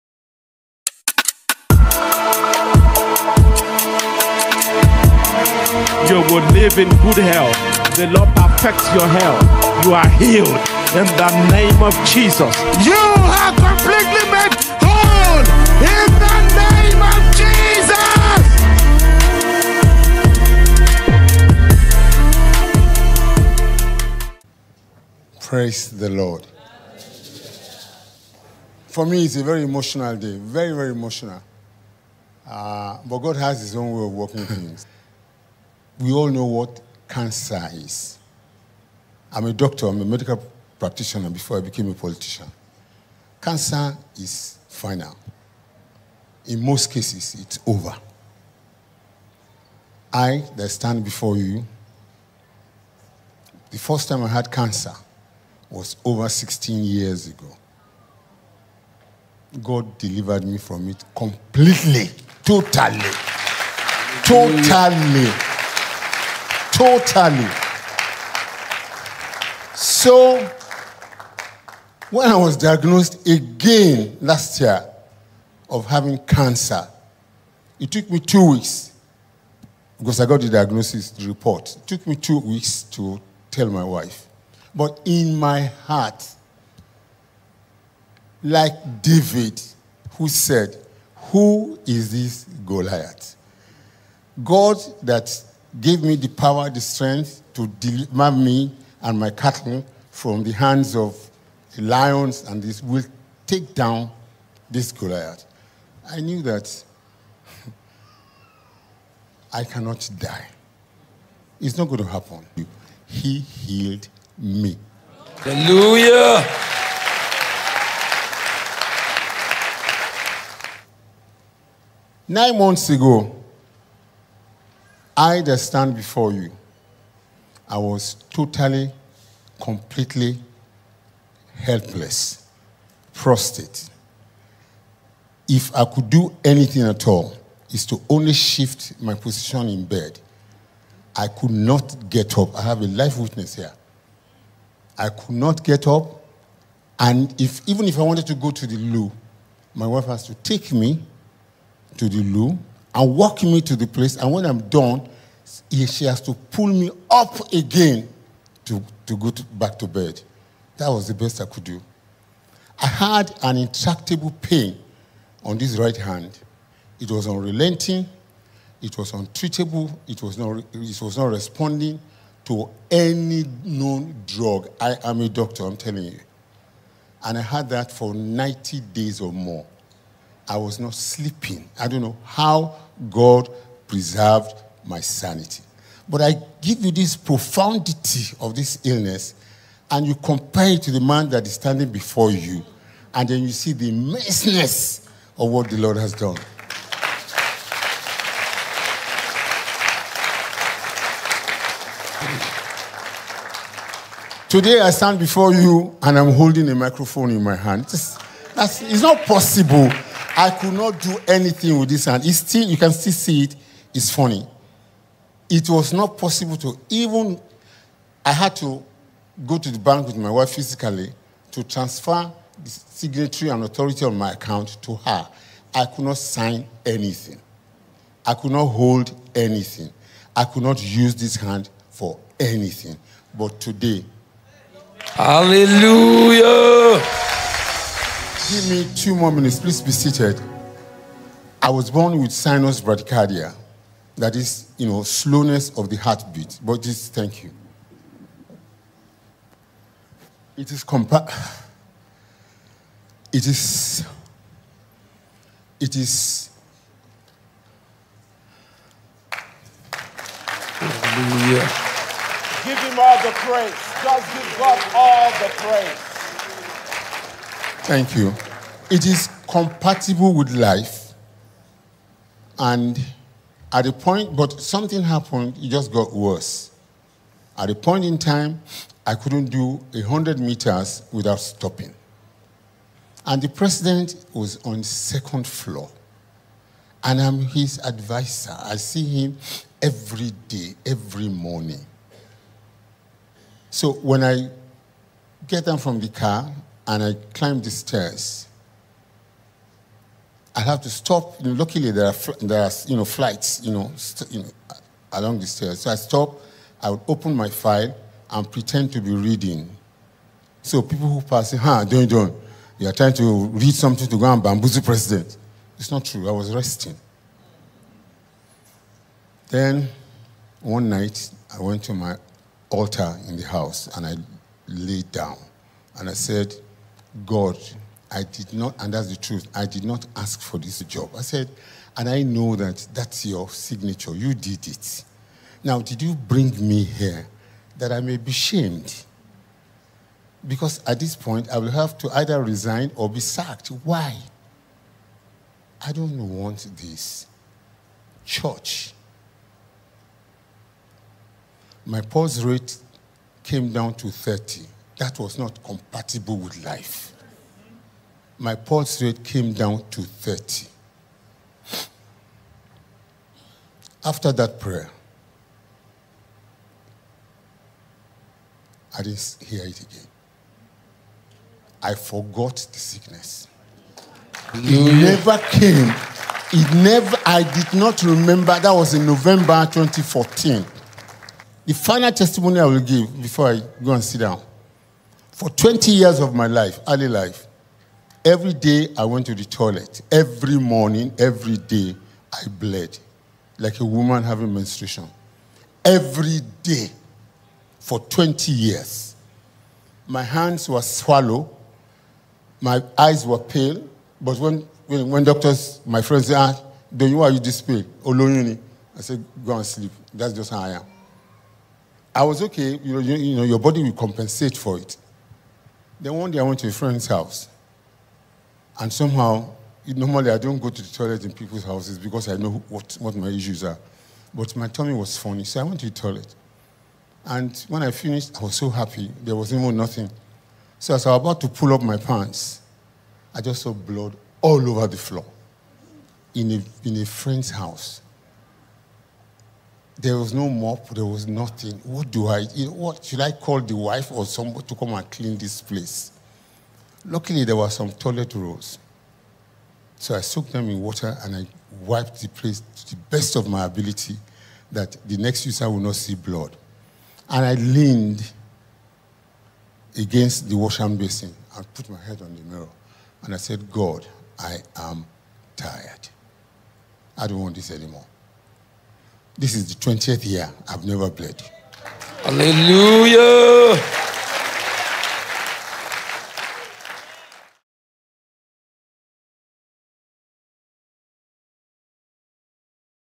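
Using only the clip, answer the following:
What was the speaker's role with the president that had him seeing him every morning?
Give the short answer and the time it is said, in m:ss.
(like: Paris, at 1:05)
Advisor, at 4:47.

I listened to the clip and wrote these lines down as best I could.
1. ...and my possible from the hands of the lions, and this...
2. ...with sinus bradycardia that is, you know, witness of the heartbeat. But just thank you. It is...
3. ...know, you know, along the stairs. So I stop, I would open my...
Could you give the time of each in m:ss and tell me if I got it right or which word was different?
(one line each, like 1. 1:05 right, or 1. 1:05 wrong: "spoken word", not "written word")
1. 1:39 wrong: "cattle", not "possible"
2. 4:02 wrong: "slowness", not "witness"
3. 5:03 right.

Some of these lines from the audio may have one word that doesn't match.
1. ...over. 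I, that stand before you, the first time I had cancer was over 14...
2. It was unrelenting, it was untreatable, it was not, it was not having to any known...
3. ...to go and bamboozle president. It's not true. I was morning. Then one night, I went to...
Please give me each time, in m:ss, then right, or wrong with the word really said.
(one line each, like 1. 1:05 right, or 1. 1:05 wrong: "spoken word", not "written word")
1. 0:47 wrong: "16", not "14"
2. 2:46 wrong: "responding", not "having"
3. 5:14 wrong: "resting", not "morning".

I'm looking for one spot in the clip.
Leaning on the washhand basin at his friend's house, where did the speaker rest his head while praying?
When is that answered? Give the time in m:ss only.
7:42.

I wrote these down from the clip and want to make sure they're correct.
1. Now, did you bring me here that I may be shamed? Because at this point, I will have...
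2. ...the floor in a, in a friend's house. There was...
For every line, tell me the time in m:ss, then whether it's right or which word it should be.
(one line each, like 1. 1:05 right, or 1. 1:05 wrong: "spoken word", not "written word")
1. 5:35 right
2. 7:14 right.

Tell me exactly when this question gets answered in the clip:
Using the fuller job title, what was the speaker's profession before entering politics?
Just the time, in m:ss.
0:40.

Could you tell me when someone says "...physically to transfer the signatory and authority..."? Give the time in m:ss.
3:40.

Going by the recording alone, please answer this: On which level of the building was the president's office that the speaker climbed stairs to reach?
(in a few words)
Second floor.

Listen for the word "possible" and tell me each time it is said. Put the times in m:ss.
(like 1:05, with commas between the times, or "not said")
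3:29, 3:36.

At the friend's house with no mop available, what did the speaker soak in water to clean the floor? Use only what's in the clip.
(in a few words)
Toilet rolls.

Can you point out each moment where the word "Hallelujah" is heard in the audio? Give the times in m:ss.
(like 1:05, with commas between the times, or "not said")
1:55, 3:55, 4:20, 7:52.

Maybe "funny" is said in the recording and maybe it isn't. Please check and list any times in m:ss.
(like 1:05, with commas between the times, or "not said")
3:34, 7:05.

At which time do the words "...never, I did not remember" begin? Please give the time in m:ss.
6:16.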